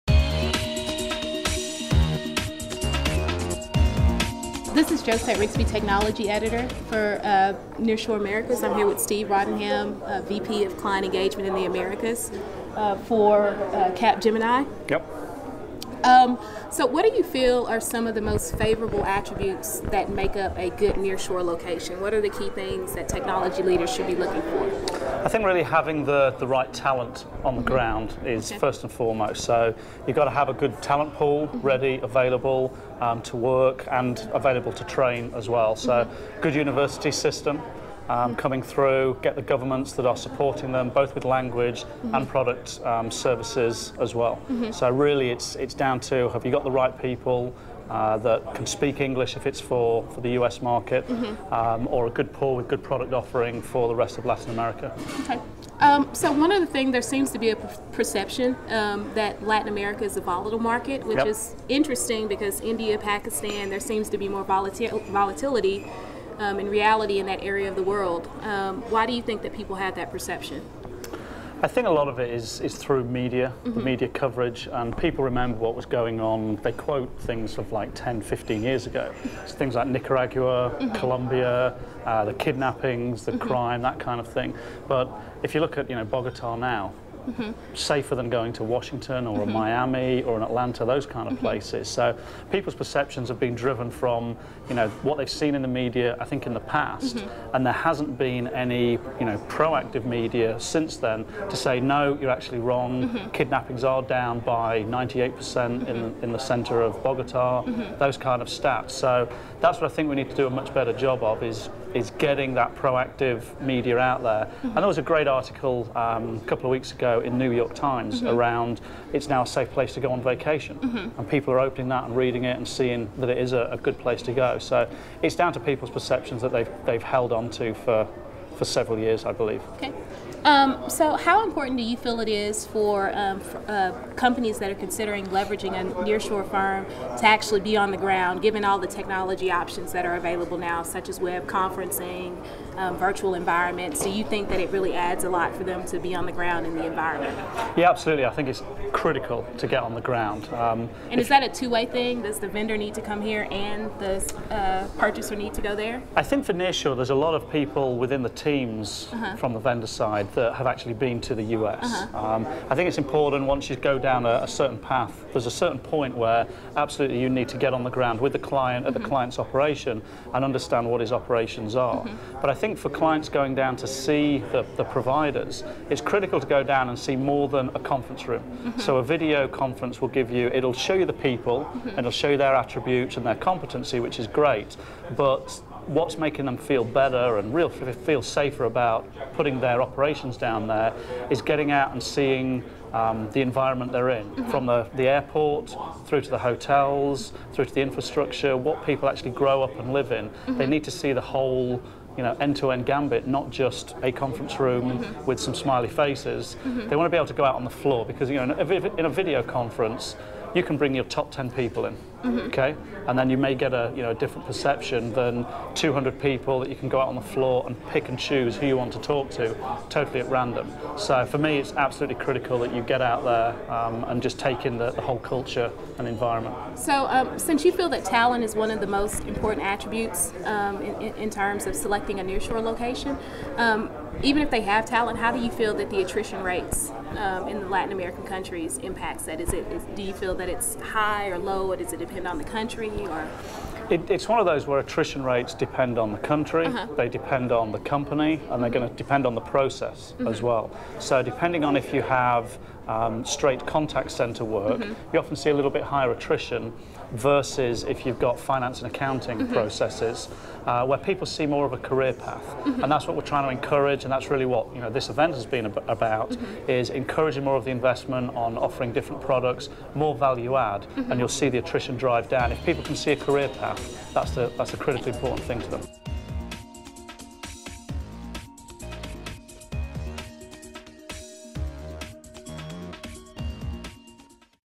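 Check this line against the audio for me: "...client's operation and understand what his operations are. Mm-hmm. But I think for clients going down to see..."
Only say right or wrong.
right.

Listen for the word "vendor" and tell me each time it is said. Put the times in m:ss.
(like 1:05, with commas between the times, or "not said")
2:32, 2:39.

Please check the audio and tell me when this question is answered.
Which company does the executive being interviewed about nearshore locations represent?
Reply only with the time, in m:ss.
0:13.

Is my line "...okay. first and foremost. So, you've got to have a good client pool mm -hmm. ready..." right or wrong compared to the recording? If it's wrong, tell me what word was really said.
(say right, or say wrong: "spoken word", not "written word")
wrong: "talent", not "client".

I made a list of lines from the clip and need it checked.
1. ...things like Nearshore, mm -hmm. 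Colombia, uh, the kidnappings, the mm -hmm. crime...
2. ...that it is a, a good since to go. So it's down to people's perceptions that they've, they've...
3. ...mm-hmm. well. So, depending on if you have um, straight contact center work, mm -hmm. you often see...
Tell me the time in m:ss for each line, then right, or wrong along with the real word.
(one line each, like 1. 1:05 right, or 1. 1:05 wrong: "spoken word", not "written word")
1. 1:19 wrong: "Nicaragua", not "Nearshore"
2. 2:03 wrong: "place", not "since"
3. 4:10 right.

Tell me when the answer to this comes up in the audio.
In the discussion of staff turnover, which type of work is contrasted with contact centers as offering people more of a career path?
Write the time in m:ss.
4:18.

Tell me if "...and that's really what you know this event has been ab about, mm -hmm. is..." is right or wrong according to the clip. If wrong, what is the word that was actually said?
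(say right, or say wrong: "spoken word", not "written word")
right.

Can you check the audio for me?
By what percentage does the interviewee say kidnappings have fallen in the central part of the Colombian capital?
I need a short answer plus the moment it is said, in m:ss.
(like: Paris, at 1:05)
98%, at 1:44.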